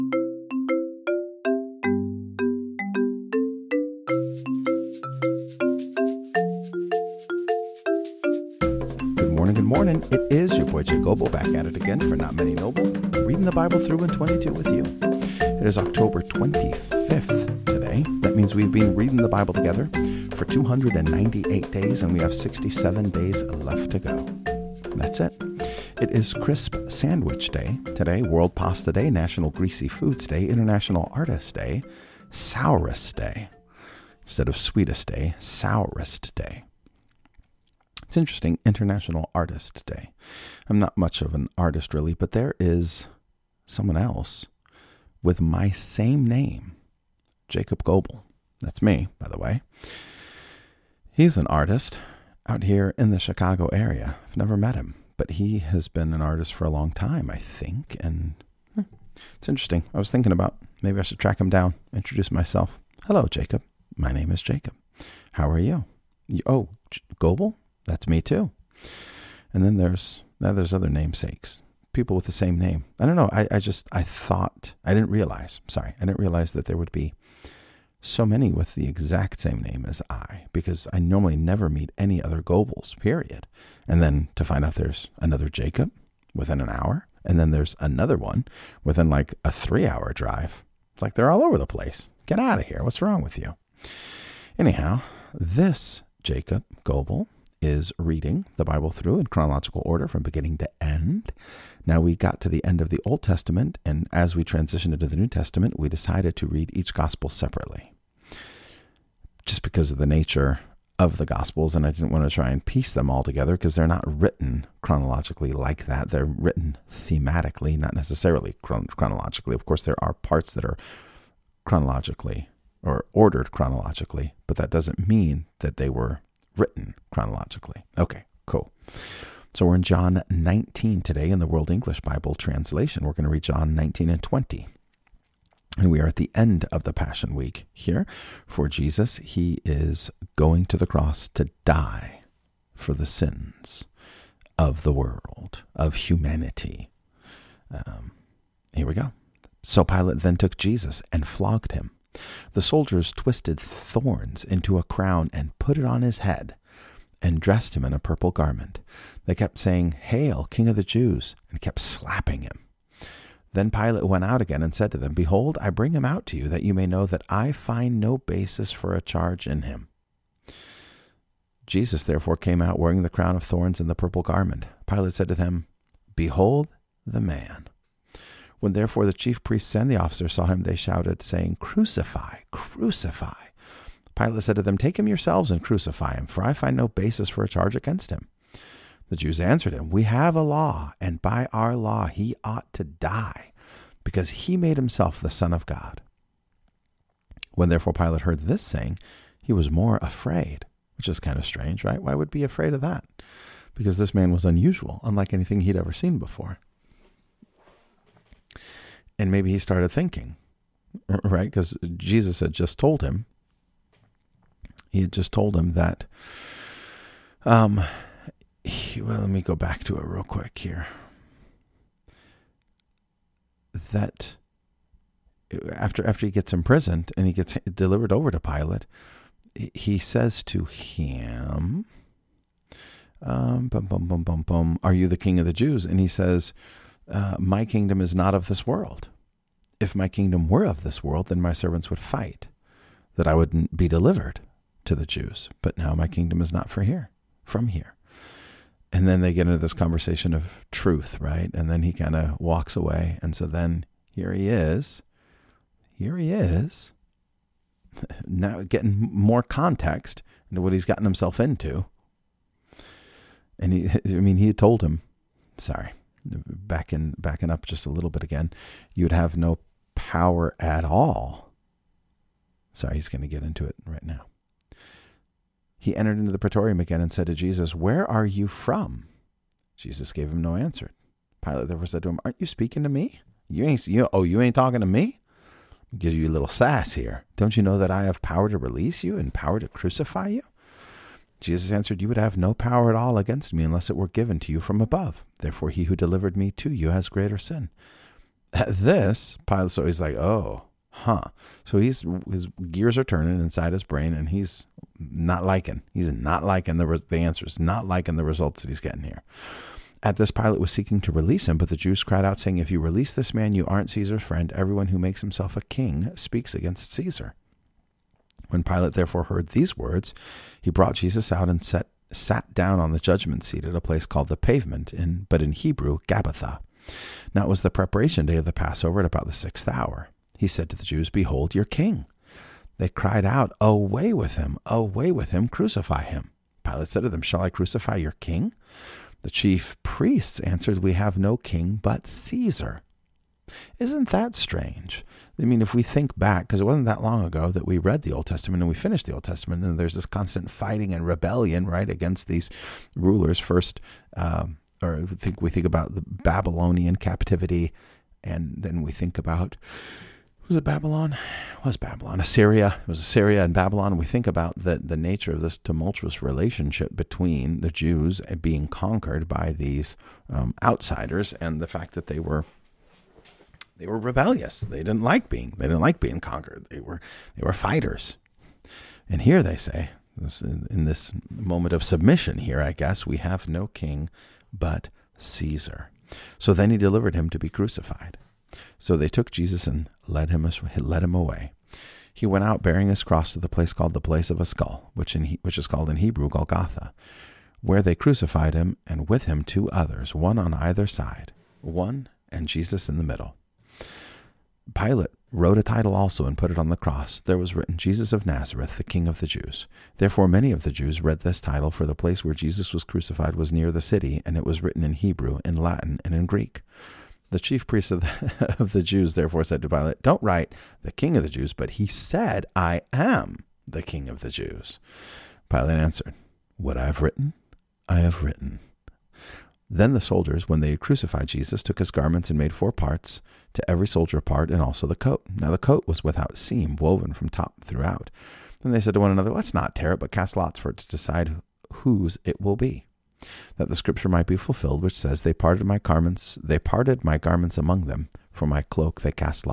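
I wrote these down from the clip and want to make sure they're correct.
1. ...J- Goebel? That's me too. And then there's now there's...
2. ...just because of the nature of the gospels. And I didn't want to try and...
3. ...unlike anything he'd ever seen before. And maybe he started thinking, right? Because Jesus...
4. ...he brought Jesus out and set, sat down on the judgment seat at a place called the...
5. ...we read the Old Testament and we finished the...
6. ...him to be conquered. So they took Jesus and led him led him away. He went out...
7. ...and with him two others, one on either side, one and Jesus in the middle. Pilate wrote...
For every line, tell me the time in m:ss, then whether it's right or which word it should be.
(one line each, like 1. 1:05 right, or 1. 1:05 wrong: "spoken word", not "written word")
1. 1:06 right
2. 1:49 right
3. 3:25 right
4. 5:20 right
5. 5:47 right
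6. 6:27 wrong: "crucified", not "conquered"
7. 6:38 right.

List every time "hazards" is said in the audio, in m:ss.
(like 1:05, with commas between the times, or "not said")
not said.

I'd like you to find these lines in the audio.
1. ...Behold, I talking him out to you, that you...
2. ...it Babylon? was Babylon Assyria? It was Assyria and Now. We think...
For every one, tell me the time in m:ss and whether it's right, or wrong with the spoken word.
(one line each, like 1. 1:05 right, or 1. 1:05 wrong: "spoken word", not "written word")
1. 2:45 wrong: "bring", not "talking"
2. 6:00 wrong: "Babylon", not "Now".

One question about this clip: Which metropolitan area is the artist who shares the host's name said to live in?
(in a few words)
Chicago.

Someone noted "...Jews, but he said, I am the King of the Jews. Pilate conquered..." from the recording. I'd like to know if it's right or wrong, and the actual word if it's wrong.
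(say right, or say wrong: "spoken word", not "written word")
wrong: "answered", not "conquered".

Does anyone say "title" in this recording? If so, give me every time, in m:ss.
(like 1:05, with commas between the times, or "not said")
6:45, 6:51.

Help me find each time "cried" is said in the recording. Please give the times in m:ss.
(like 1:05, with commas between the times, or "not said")
5:12, 5:32.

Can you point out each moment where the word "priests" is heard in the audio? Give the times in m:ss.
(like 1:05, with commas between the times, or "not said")
2:59, 5:39, 6:57.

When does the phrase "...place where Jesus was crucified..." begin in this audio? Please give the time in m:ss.
6:51.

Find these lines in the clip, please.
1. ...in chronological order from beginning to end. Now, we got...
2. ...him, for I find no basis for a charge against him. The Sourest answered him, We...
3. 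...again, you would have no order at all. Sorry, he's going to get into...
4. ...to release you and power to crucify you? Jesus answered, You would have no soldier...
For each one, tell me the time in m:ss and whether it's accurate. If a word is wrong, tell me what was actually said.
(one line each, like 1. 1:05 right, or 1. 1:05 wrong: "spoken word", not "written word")
1. 1:39 right
2. 3:06 wrong: "Jews", not "Sourest"
3. 4:28 wrong: "power", not "order"
4. 4:48 wrong: "power", not "soldier".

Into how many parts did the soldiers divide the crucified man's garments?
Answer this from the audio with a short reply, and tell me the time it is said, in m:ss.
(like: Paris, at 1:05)
4, at 7:12.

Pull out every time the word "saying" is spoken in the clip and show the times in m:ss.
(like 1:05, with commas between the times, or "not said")
2:39, 3:01, 3:18, 5:12.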